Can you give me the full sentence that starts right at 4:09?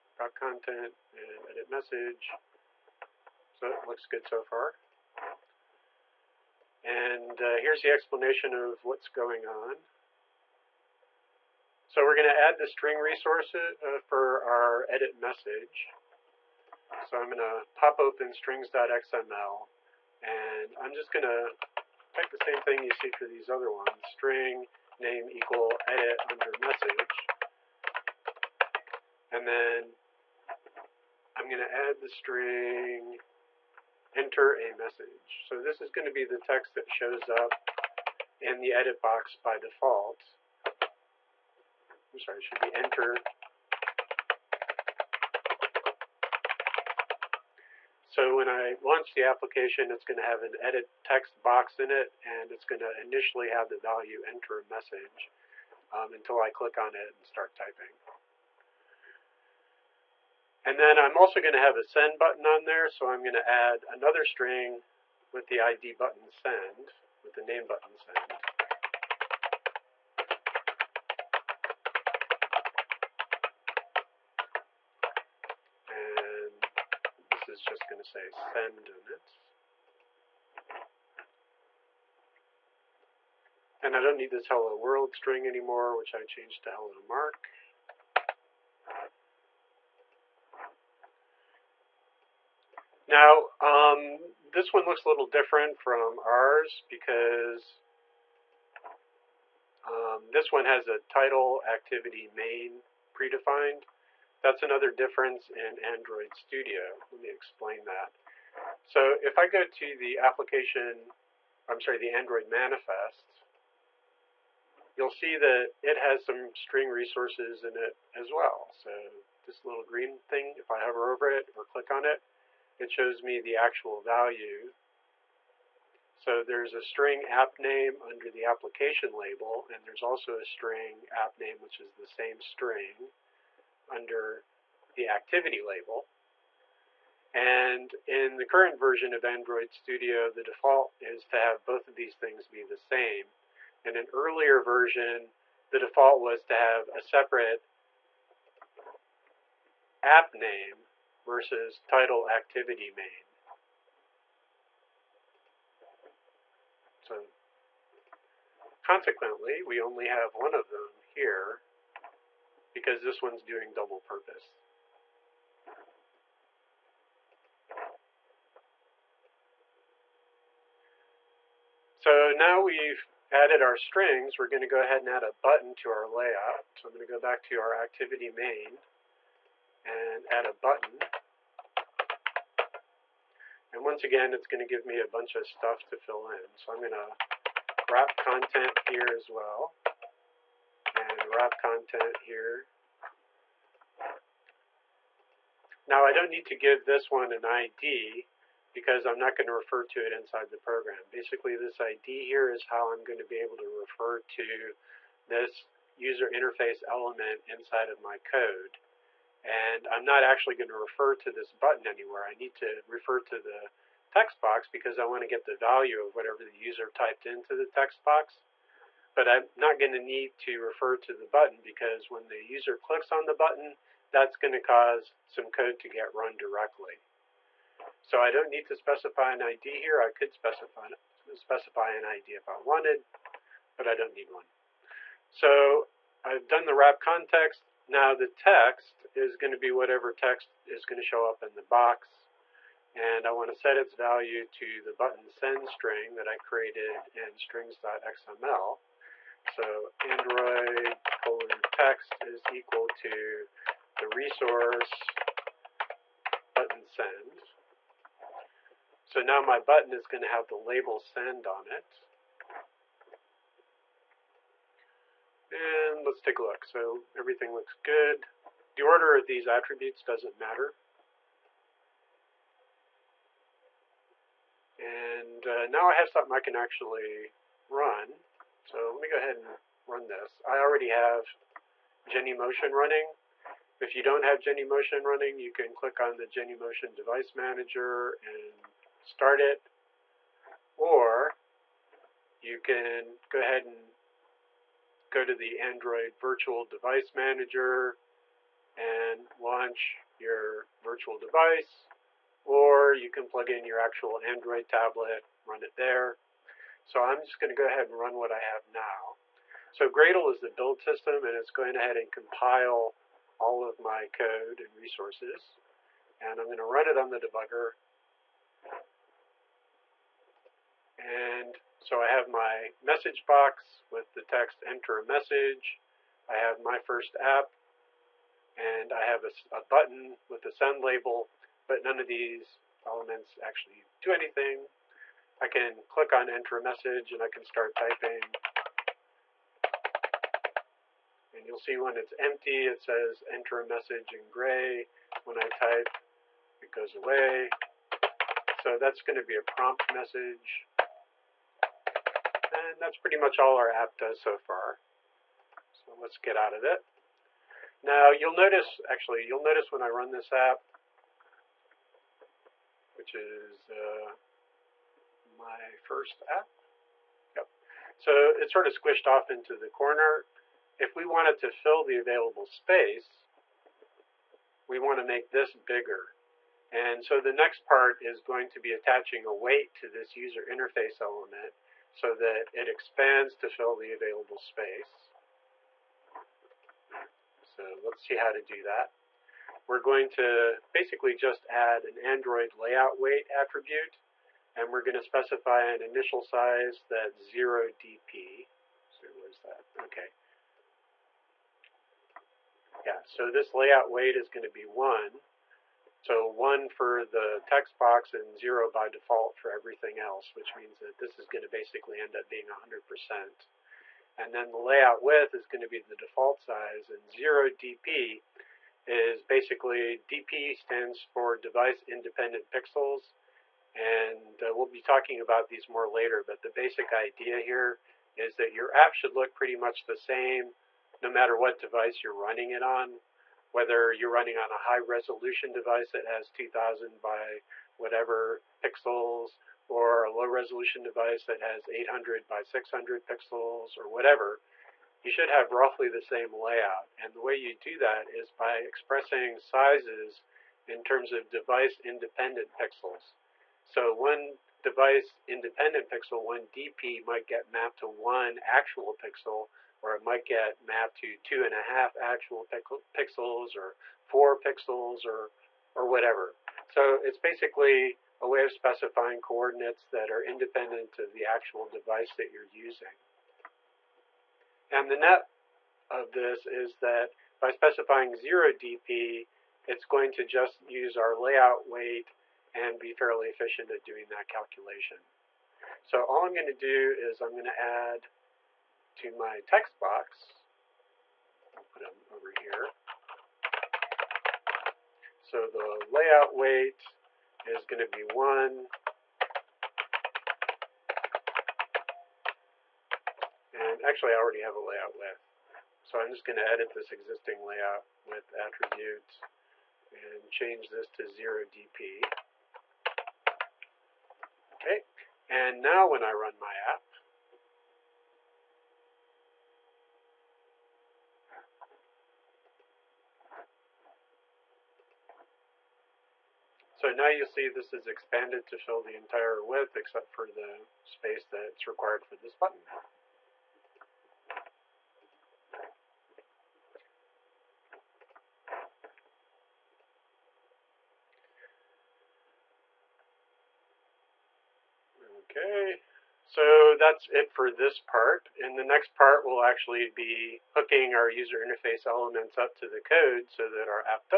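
So Android colon text is equal to the resource button send.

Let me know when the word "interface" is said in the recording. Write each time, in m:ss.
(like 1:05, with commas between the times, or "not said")
3:26, 6:20, 9:11.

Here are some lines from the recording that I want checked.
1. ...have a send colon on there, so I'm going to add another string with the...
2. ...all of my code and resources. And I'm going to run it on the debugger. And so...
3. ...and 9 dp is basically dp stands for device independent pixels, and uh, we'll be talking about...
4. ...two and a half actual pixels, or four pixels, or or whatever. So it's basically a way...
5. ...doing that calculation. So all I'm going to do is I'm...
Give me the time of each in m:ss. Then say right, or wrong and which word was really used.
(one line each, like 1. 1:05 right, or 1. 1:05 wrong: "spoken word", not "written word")
1. 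1:01 wrong: "button", not "colon"
2. 5:13 right
3. 6:56 wrong: "0", not "9"
4. 7:41 right
5. 8:03 right.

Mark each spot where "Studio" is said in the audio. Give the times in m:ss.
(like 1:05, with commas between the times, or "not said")
1:46, 2:19.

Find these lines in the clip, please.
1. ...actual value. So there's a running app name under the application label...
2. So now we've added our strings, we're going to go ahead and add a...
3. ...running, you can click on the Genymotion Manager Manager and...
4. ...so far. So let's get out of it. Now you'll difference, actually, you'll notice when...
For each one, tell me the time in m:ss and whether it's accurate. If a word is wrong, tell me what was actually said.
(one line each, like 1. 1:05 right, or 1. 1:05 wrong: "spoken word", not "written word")
1. 2:03 wrong: "string", not "running"
2. 2:51 right
3. 4:45 wrong: "Device", not "Manager"
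4. 5:54 wrong: "notice", not "difference".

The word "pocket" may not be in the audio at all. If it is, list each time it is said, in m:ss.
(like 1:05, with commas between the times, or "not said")
not said.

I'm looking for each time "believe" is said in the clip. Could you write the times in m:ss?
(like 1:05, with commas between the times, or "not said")
not said.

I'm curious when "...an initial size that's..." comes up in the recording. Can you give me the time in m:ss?
6:35.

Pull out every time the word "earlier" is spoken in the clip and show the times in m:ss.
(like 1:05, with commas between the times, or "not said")
2:24.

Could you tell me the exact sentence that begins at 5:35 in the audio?
I can click on enter a message and I can start typing.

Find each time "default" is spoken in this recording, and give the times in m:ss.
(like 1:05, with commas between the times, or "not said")
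0:39, 2:20, 2:25, 6:48, 6:55.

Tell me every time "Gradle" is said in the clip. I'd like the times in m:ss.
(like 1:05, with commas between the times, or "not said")
5:09.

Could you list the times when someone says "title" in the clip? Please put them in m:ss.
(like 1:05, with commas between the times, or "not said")
1:40, 2:31.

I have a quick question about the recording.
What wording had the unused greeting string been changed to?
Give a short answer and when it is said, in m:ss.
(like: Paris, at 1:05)
Hello Mark, at 1:26.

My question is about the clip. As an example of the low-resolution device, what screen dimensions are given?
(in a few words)
800 by 600.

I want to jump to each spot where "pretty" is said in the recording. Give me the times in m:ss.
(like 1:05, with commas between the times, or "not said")
5:52, 7:09.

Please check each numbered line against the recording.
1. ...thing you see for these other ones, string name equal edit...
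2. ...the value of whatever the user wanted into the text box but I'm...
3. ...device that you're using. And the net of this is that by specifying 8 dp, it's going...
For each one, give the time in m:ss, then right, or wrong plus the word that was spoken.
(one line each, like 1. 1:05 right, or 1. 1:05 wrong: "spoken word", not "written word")
1. 0:22 right
2. 3:35 wrong: "typed", not "wanted"
3. 7:51 wrong: "0", not "8".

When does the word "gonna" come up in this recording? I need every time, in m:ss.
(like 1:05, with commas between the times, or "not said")
not said.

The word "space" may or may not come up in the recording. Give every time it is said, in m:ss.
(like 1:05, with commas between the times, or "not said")
6:12, 6:24, 8:50.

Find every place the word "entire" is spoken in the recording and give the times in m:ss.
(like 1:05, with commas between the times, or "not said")
8:48.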